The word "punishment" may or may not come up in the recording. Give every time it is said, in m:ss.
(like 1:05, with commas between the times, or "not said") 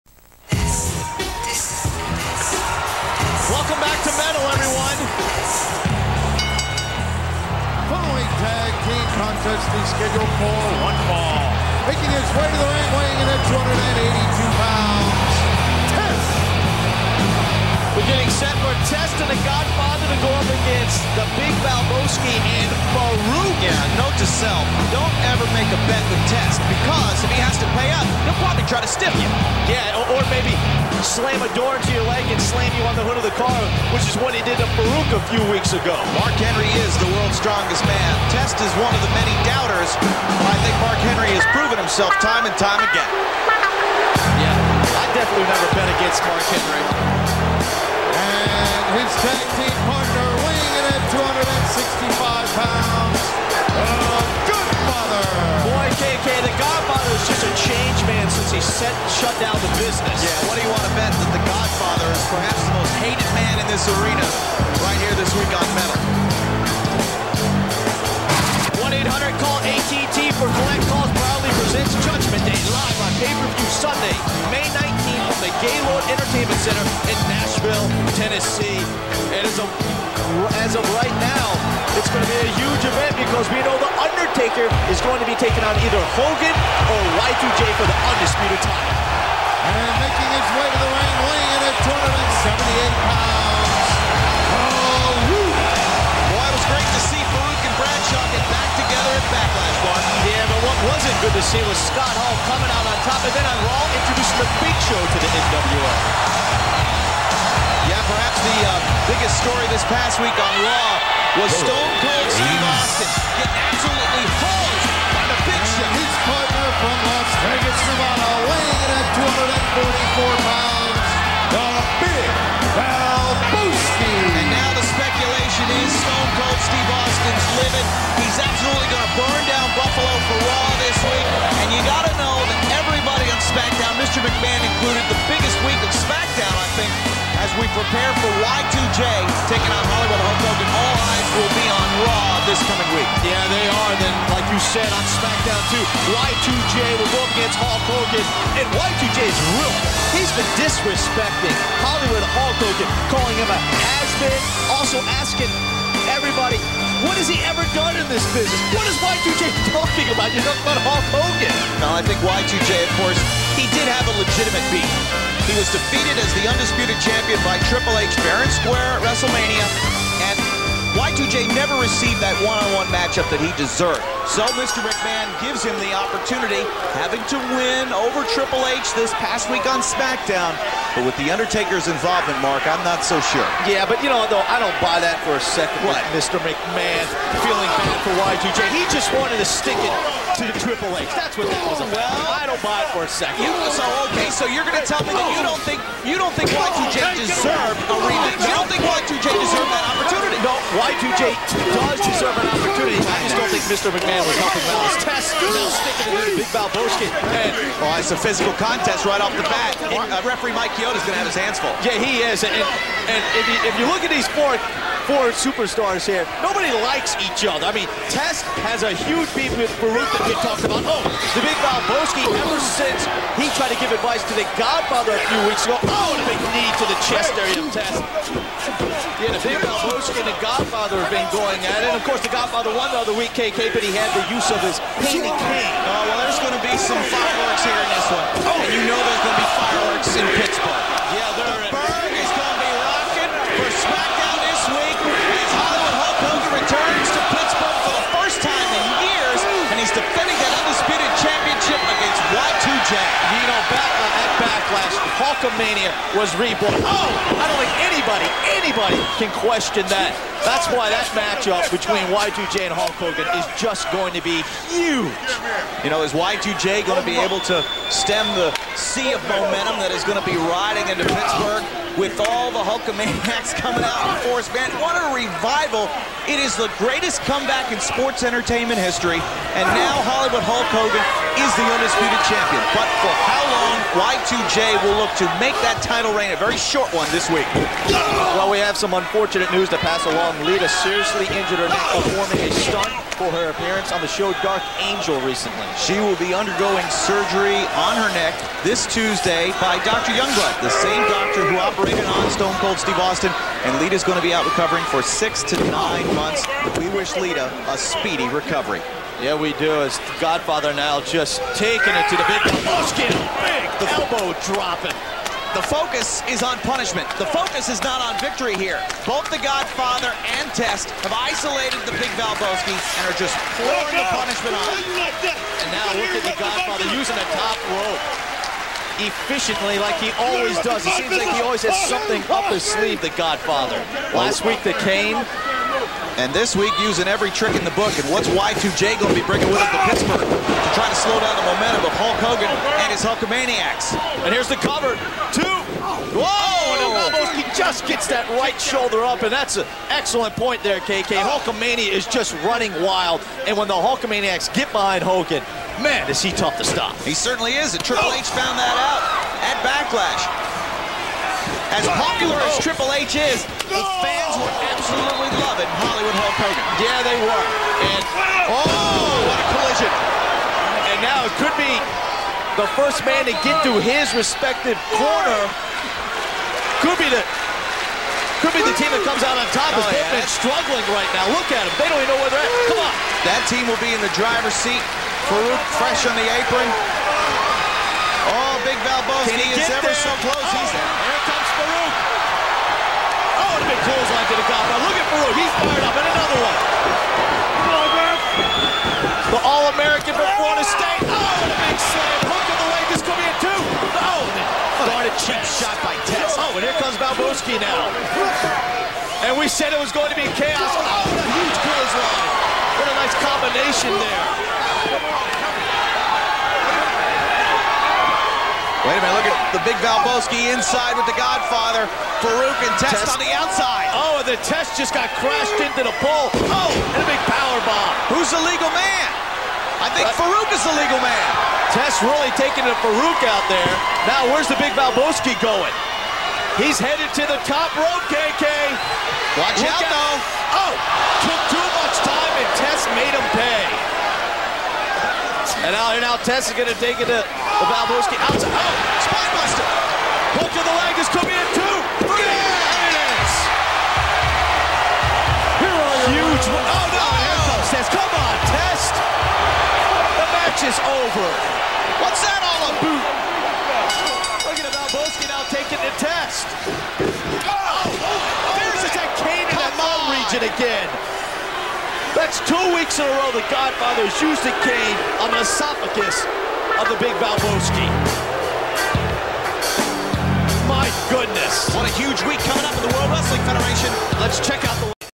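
5:16, 5:24.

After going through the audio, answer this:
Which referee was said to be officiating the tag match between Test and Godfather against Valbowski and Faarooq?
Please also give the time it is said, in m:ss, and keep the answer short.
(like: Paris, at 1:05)
Mike Chioda, at 3:30.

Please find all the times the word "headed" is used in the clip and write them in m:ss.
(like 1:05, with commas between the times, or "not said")
7:16.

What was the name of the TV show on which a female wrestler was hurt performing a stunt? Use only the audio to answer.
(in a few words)
Dark Angel.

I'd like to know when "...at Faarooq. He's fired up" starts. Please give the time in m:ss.
6:34.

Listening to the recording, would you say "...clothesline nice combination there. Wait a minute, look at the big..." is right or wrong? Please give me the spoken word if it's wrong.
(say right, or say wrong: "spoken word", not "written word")
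right.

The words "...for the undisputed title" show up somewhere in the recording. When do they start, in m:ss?
1:27.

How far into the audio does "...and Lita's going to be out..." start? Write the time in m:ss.
5:03.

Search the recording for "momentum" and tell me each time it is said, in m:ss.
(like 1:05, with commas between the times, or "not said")
4:29, 5:41.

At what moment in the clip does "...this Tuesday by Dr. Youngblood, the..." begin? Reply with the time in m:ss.
4:58.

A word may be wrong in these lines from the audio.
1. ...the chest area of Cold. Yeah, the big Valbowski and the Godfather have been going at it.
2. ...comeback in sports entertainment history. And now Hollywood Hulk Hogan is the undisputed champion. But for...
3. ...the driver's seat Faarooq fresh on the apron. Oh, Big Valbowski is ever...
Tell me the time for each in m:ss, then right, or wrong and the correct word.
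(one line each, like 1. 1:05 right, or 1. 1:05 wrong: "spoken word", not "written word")
1. 3:46 wrong: "Test", not "Cold"
2. 4:37 right
3. 6:24 right.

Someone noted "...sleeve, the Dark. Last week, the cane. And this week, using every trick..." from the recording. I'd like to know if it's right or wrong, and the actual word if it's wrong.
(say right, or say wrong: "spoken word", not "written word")
wrong: "Godfather", not "Dark".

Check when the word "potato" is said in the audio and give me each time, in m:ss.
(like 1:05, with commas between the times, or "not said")
not said.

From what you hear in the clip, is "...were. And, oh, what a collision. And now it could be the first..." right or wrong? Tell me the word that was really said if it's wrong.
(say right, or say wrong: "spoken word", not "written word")
right.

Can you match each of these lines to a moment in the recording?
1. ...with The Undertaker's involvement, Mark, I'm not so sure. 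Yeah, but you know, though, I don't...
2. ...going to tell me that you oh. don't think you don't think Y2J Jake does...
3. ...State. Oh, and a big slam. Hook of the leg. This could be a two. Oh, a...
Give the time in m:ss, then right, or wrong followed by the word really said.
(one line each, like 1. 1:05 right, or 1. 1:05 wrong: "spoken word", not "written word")
1. 3:01 right
2. 3:14 right
3. 6:40 right.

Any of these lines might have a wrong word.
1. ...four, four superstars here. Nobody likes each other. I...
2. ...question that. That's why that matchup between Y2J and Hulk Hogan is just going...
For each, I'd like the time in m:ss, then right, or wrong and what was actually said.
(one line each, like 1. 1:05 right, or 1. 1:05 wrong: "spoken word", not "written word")
1. 3:34 right
2. 4:19 right.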